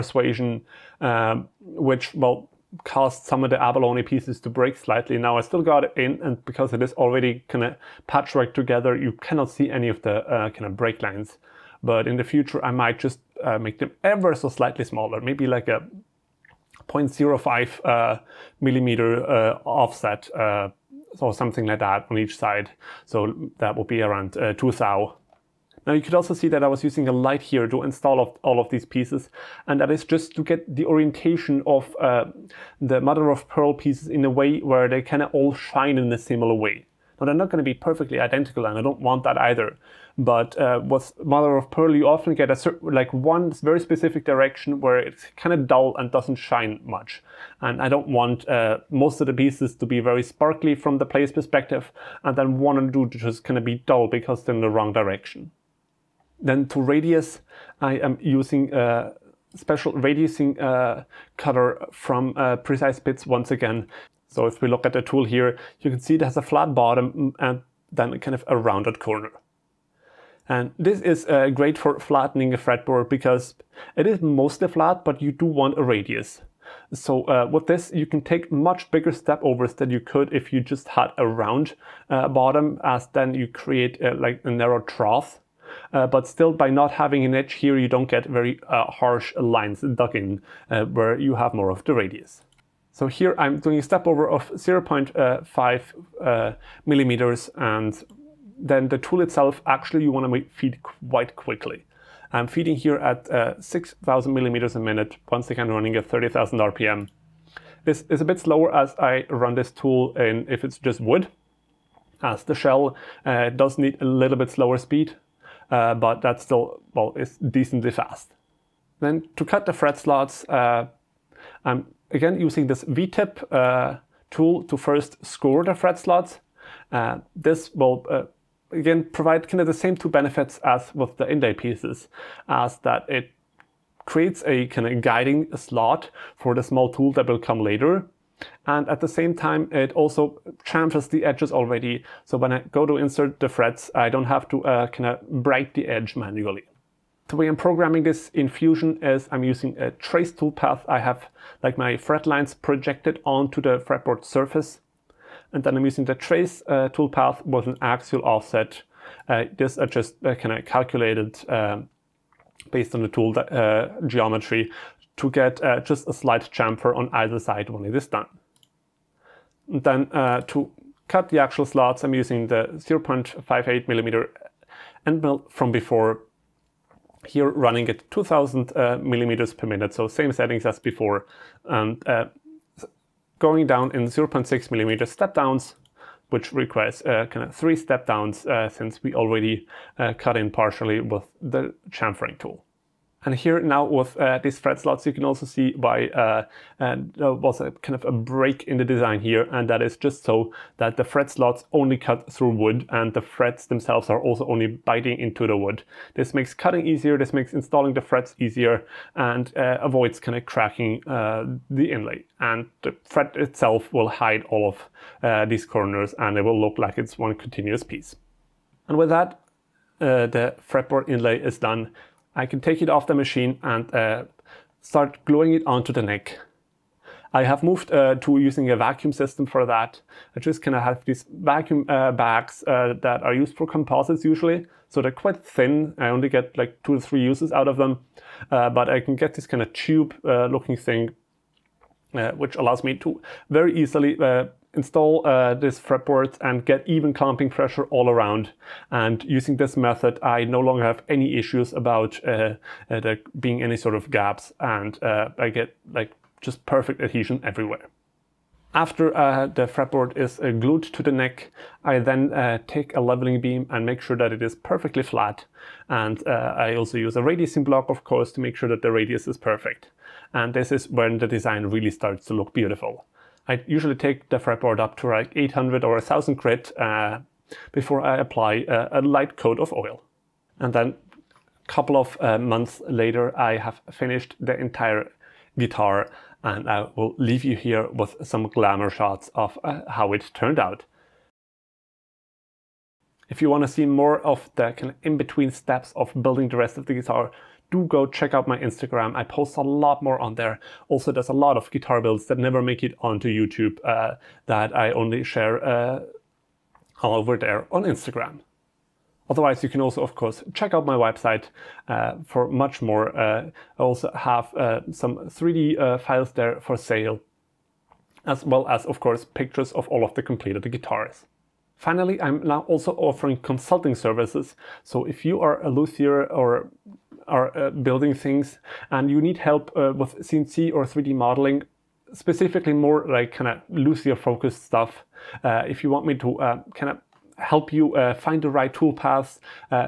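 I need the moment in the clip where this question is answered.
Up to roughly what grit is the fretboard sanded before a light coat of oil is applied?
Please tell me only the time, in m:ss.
4:35.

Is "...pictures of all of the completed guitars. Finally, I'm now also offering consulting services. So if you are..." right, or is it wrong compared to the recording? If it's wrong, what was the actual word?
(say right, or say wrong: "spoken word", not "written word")
right.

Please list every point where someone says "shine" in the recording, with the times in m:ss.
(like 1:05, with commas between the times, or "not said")
0:35, 0:46.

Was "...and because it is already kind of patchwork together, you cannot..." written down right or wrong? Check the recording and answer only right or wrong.
right.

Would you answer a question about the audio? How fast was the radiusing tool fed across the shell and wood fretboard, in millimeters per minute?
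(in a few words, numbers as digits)
6,000 millimeters a minute.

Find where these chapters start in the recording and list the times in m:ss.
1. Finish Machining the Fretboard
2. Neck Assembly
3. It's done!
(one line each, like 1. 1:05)
1. 0:55
2. 3:39
3. 4:39.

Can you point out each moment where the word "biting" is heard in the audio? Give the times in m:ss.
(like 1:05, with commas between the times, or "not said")
3:24.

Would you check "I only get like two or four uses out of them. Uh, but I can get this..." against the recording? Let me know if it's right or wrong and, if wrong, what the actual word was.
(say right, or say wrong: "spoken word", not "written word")
wrong: "three", not "four".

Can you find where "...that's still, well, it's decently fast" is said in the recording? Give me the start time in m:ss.
1:56.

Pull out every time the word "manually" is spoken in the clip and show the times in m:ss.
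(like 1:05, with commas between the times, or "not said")
2:26.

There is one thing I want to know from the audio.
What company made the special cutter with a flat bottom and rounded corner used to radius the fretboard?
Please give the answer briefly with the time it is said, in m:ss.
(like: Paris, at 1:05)
Precise Bits, at 1:02.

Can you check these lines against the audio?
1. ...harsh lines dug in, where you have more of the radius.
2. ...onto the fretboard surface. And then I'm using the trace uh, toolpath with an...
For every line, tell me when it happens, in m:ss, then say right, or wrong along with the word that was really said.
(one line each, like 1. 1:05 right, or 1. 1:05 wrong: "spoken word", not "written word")
1. 1:28 right
2. 2:33 right.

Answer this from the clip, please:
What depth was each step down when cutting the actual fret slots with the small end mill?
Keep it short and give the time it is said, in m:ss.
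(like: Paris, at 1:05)
0.6 millimeter, at 3:04.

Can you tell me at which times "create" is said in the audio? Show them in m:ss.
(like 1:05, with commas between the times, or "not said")
1:23, 2:14.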